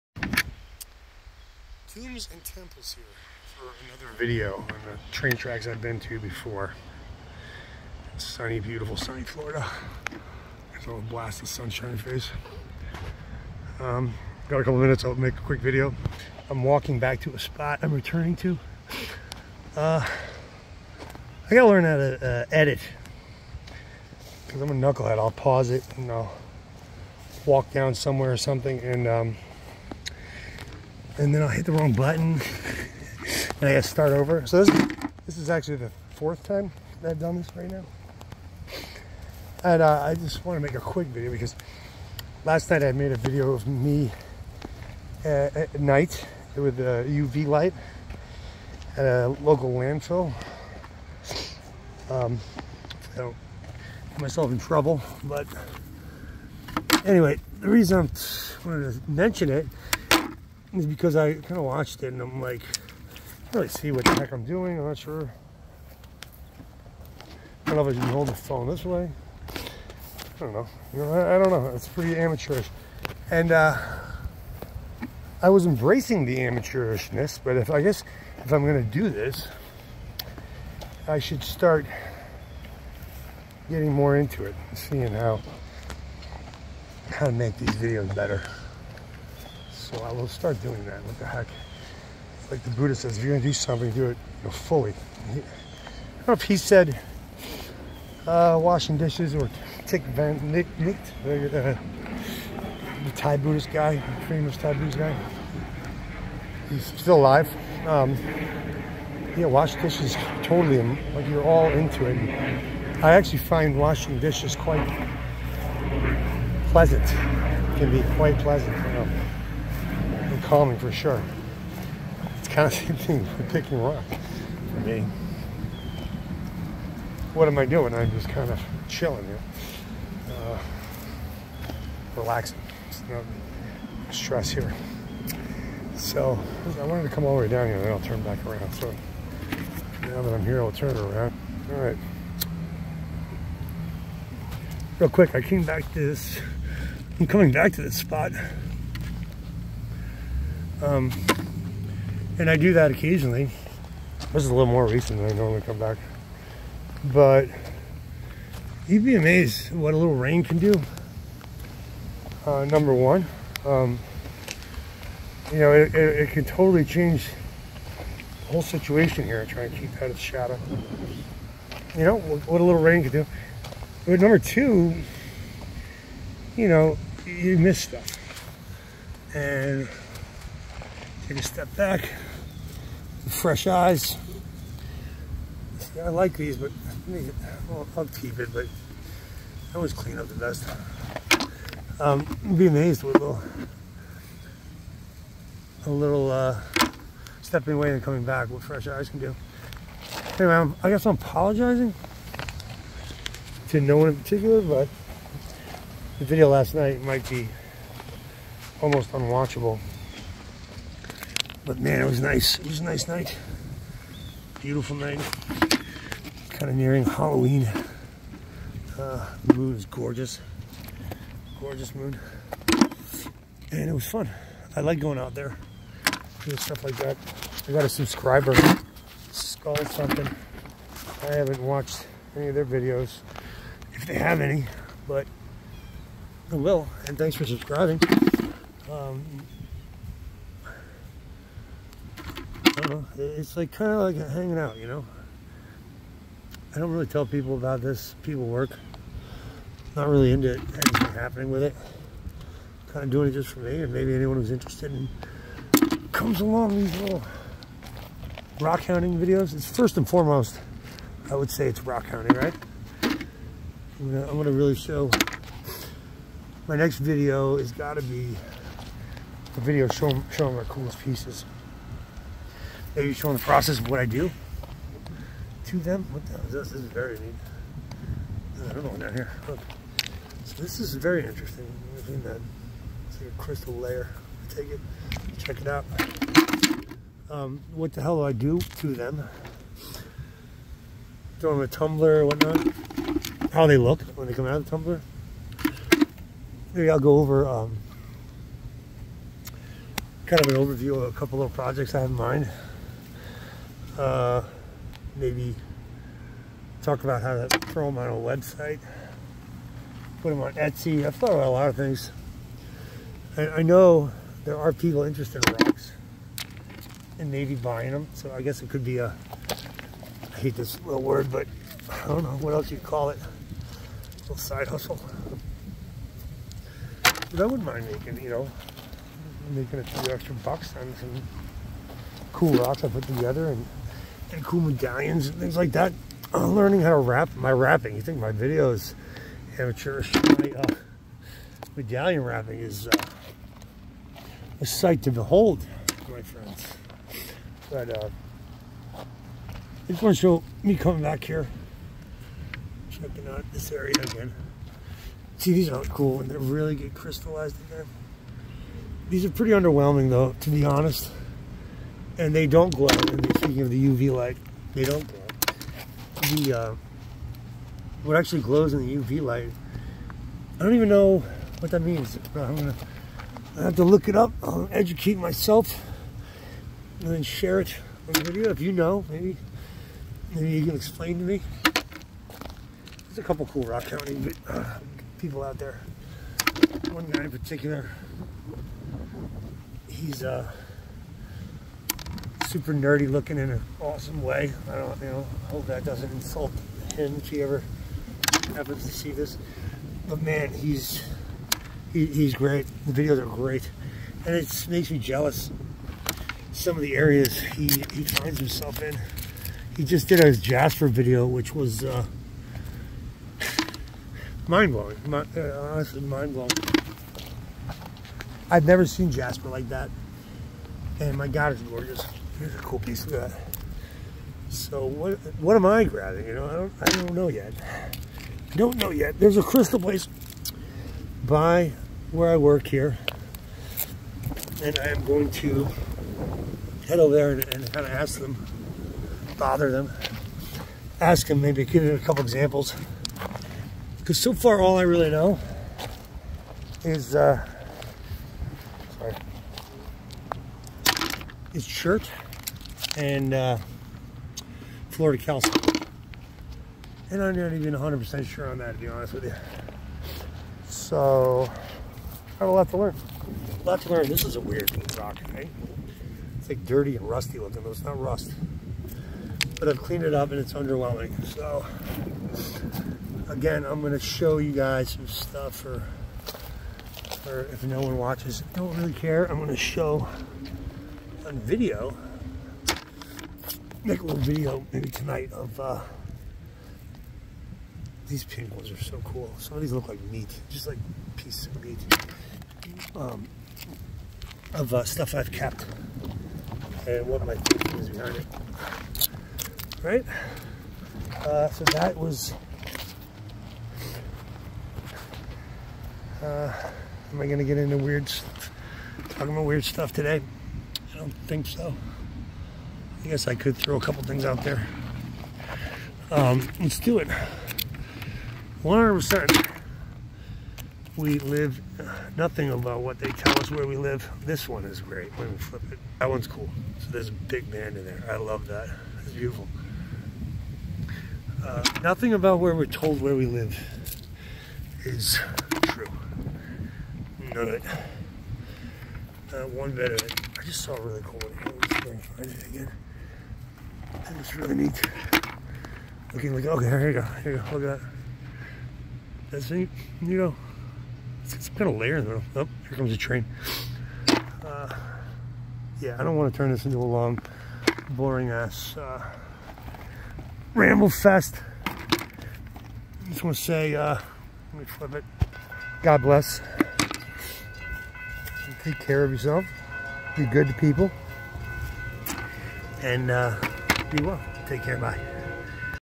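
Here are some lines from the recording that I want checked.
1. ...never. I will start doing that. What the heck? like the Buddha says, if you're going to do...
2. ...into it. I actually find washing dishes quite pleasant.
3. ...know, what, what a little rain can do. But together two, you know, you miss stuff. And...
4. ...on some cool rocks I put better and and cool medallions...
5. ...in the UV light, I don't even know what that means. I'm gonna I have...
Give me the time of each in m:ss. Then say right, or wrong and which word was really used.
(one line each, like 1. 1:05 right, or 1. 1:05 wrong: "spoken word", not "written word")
1. 1:28 wrong: "better", not "never"
2. 1:51 right
3. 2:52 wrong: "number", not "together"
4. 5:30 wrong: "together", not "better"
5. 6:08 right.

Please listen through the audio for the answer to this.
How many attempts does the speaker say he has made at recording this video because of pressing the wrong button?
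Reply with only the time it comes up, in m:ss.
0:36.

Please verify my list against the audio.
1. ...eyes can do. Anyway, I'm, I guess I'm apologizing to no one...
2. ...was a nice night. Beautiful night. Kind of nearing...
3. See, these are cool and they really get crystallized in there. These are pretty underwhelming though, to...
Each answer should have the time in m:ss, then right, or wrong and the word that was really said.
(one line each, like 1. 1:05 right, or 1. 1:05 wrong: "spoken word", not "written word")
1. 3:18 right
2. 3:32 right
3. 5:55 right.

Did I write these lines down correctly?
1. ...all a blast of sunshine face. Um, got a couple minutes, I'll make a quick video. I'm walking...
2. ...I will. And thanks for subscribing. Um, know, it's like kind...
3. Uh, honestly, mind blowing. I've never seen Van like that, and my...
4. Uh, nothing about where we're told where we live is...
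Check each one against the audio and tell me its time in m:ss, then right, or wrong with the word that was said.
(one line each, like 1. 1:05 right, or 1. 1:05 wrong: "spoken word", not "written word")
1. 0:10 right
2. 3:56 right
3. 6:55 wrong: "Jasper", not "Van"
4. 8:51 right.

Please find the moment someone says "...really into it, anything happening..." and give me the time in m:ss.
4:10.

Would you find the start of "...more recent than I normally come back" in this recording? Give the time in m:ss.
2:34.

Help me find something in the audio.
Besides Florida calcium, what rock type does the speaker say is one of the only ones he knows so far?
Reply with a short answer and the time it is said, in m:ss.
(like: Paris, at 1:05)
chert, at 7:31.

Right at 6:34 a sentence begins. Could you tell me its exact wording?
I don't, you know, hope that doesn't insult him if he ever happens to see this.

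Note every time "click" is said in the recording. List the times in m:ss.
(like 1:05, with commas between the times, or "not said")
not said.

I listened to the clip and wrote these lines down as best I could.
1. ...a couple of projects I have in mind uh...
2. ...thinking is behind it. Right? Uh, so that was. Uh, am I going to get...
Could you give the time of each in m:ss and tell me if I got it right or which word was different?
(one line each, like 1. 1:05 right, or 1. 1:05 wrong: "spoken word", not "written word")
1. 5:01 right
2. 8:17 right.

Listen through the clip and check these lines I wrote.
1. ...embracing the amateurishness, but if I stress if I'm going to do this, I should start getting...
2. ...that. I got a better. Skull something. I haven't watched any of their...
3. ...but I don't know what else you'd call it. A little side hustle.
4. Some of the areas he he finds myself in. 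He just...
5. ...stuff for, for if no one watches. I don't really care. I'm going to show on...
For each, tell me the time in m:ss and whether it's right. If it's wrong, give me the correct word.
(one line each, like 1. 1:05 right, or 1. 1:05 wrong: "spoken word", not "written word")
1. 1:15 wrong: "guess", not "stress"
2. 3:46 wrong: "subscriber", not "better"
3. 5:21 right
4. 6:46 wrong: "himself", not "myself"
5. 7:55 right.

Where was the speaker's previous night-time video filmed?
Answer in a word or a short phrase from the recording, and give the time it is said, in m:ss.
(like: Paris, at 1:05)
a local landfill, at 0:49.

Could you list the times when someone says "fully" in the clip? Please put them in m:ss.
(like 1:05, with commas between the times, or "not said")
1:34.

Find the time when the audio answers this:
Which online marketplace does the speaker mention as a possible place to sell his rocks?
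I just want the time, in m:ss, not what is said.
5:10.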